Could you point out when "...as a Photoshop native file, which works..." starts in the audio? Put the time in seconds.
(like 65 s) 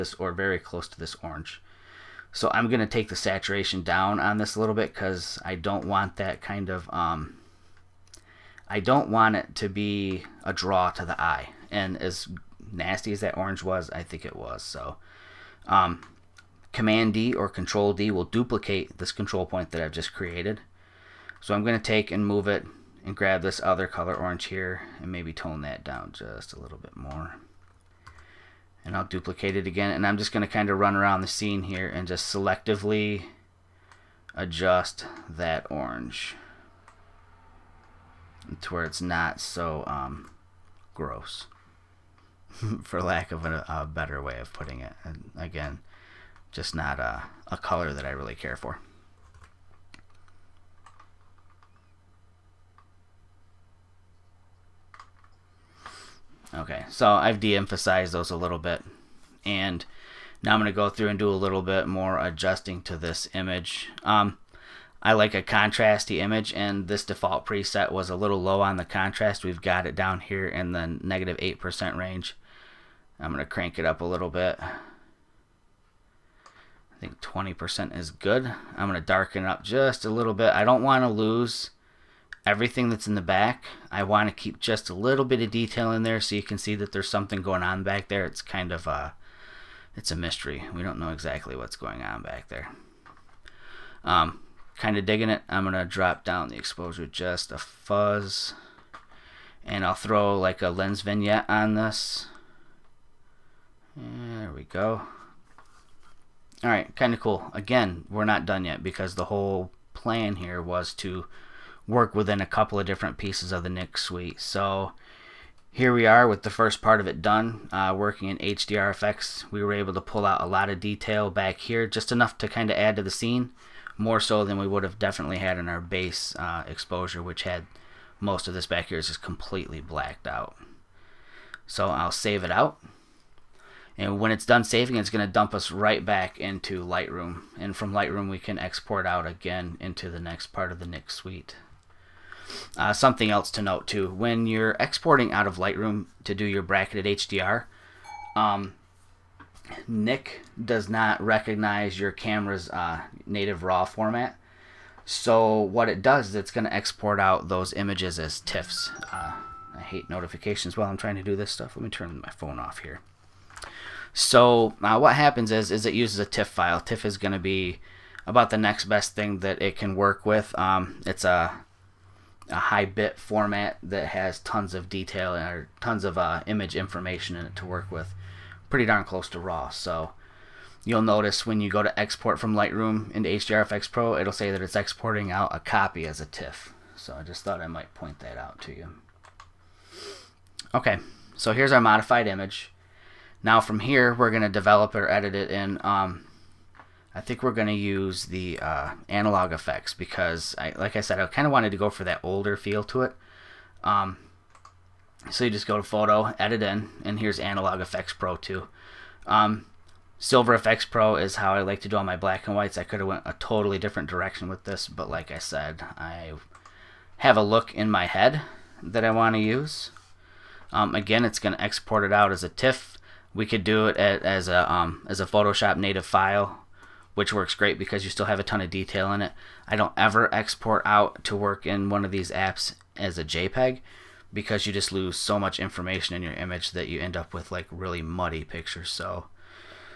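225 s.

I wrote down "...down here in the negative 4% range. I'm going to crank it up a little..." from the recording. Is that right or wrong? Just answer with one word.
wrong.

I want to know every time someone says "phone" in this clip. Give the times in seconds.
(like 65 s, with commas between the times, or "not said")
162 s.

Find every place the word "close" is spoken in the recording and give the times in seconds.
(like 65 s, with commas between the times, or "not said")
0 s, 179 s.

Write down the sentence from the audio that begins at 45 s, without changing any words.
And again, just not a, a color that I really care for.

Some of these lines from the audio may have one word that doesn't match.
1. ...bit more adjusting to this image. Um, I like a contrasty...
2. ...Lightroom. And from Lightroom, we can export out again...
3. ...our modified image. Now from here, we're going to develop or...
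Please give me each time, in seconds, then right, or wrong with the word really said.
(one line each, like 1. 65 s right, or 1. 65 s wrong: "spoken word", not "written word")
1. 61 s right
2. 136 s right
3. 191 s right.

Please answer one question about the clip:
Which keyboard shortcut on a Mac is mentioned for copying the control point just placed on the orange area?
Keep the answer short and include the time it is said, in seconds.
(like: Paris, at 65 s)
Command D, at 16 s.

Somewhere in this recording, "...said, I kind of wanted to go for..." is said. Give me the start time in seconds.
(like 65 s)
201 s.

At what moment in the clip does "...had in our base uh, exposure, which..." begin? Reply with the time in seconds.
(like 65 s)
125 s.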